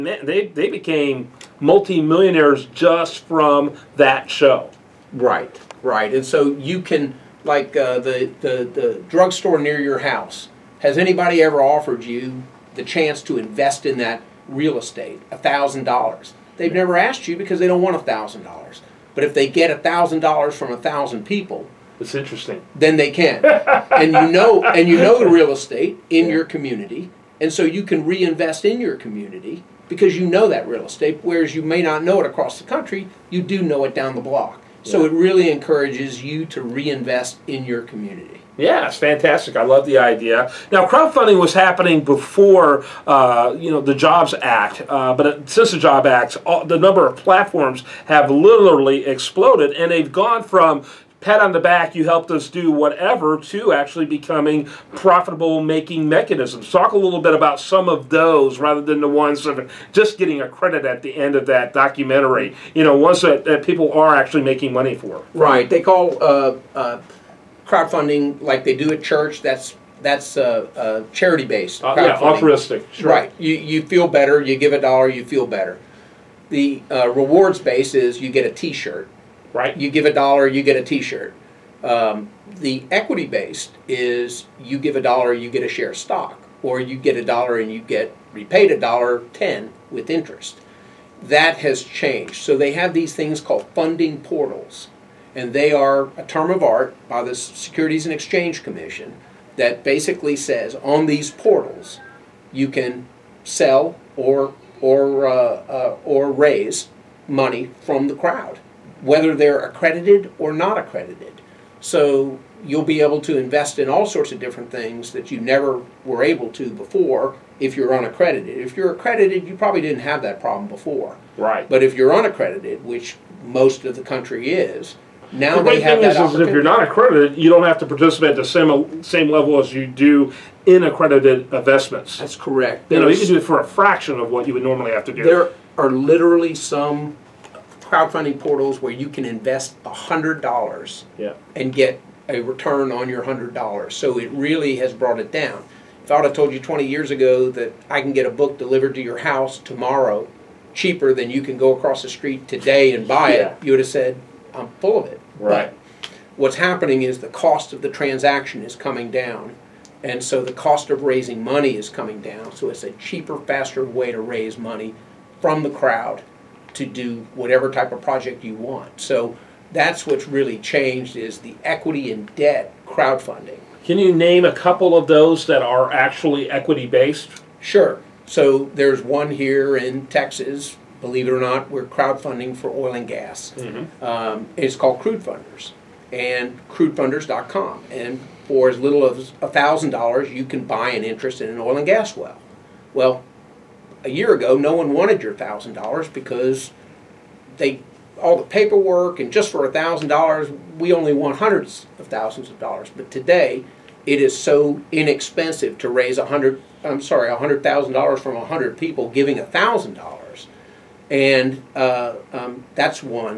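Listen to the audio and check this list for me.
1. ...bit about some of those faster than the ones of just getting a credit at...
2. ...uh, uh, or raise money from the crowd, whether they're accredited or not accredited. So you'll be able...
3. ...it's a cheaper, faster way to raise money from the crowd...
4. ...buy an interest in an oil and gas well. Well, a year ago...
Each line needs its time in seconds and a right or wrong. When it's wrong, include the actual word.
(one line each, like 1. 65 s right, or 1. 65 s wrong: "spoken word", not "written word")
1. 57 s wrong: "rather", not "faster"
2. 105 s right
3. 162 s right
4. 190 s right.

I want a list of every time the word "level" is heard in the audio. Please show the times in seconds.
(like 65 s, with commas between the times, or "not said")
129 s.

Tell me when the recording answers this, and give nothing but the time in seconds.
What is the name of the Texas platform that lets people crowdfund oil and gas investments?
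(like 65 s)
184 s.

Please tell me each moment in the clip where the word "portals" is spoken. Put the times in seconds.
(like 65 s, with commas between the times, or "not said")
94 s, 101 s, 138 s.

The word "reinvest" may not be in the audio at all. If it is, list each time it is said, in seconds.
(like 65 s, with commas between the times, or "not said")
28 s, 36 s.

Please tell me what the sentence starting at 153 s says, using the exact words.
it, you would have said, I'm full of it.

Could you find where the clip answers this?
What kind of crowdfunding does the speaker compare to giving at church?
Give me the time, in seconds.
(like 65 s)
71 s.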